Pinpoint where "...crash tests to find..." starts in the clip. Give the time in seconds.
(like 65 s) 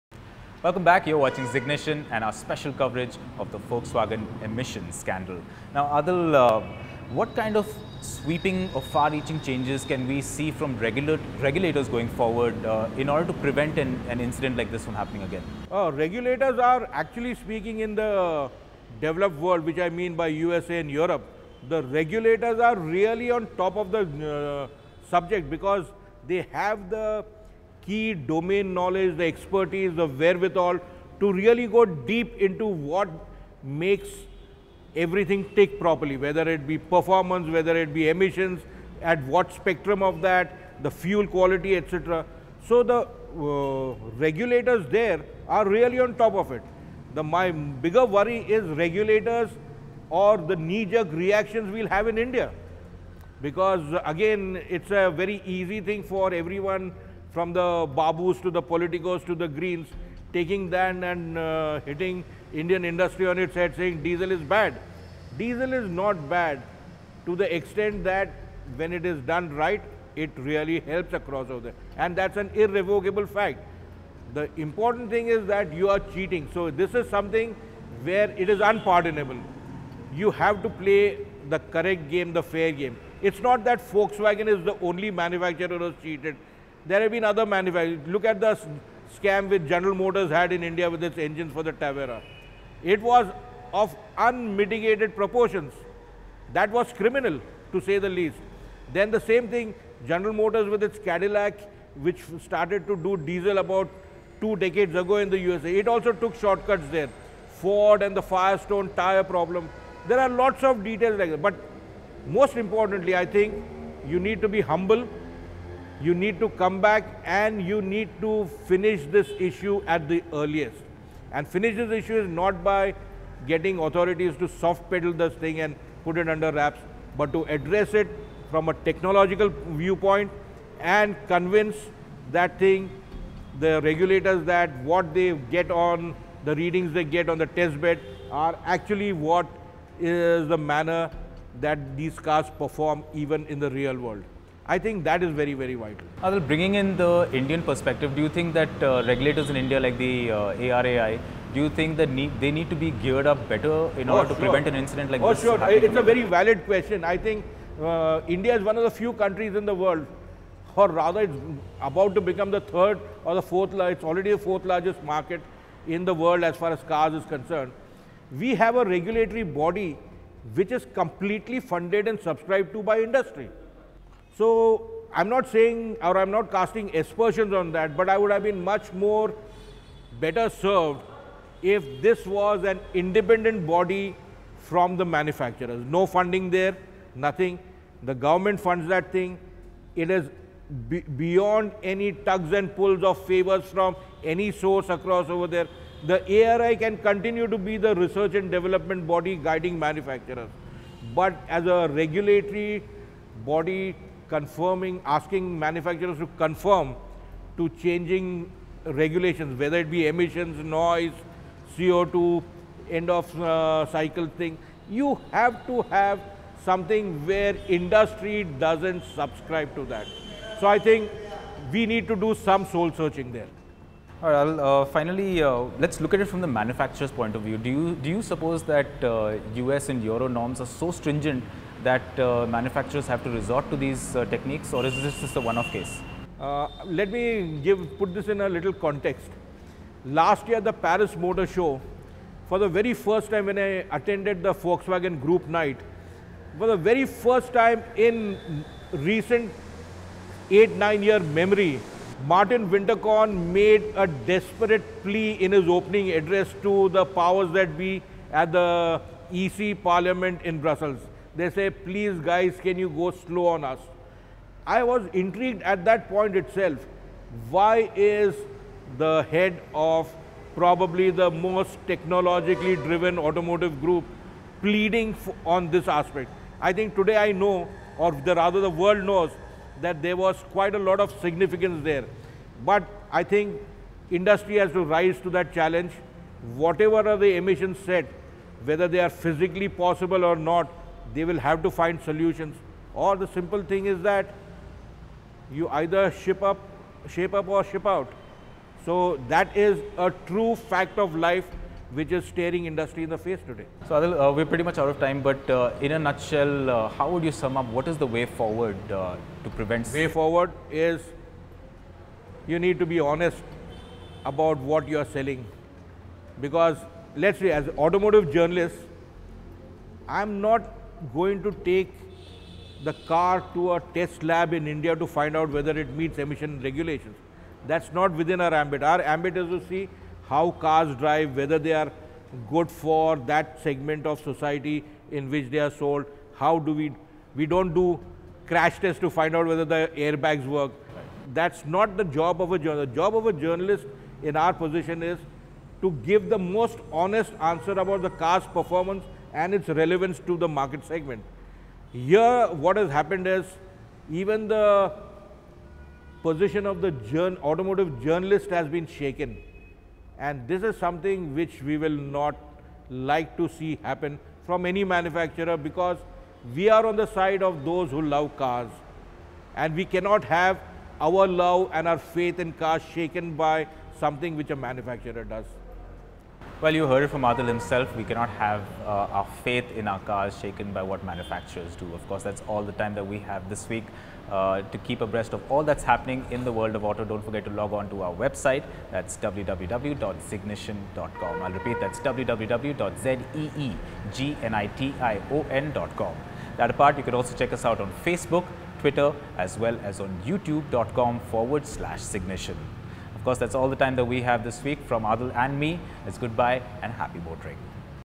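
338 s.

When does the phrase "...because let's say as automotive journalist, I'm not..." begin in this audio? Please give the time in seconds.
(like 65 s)
316 s.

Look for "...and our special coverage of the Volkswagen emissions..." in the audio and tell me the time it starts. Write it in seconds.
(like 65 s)
2 s.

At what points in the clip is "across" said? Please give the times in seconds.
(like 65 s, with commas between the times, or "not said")
71 s, 194 s.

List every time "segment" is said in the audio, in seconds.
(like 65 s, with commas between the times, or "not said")
333 s, 350 s.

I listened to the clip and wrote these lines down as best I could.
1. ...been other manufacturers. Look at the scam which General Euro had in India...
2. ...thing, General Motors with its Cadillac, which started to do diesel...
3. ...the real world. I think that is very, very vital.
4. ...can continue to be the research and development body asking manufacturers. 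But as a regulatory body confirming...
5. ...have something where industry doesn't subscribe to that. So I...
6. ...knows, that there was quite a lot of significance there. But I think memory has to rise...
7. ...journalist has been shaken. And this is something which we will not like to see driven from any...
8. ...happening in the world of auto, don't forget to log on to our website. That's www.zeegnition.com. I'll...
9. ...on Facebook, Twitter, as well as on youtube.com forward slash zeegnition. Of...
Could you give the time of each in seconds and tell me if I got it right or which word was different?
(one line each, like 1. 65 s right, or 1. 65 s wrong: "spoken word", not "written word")
1. 87 s wrong: "Motors", not "Euro"
2. 99 s right
3. 143 s right
4. 196 s wrong: "guiding", not "asking"
5. 215 s right
6. 279 s wrong: "industry", not "memory"
7. 358 s wrong: "happen", not "driven"
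8. 385 s right
9. 397 s right.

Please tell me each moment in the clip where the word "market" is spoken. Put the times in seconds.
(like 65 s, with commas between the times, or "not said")
165 s, 350 s.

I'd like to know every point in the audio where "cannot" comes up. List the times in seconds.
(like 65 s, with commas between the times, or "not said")
369 s, 378 s.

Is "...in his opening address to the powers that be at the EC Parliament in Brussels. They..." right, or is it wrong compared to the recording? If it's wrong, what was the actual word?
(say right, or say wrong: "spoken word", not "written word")
right.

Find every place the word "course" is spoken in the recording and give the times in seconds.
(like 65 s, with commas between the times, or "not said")
382 s, 403 s.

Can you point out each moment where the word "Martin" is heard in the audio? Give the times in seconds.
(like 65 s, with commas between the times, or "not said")
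252 s.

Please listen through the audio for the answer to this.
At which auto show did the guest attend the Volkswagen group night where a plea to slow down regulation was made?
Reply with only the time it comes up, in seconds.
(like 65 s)
240 s.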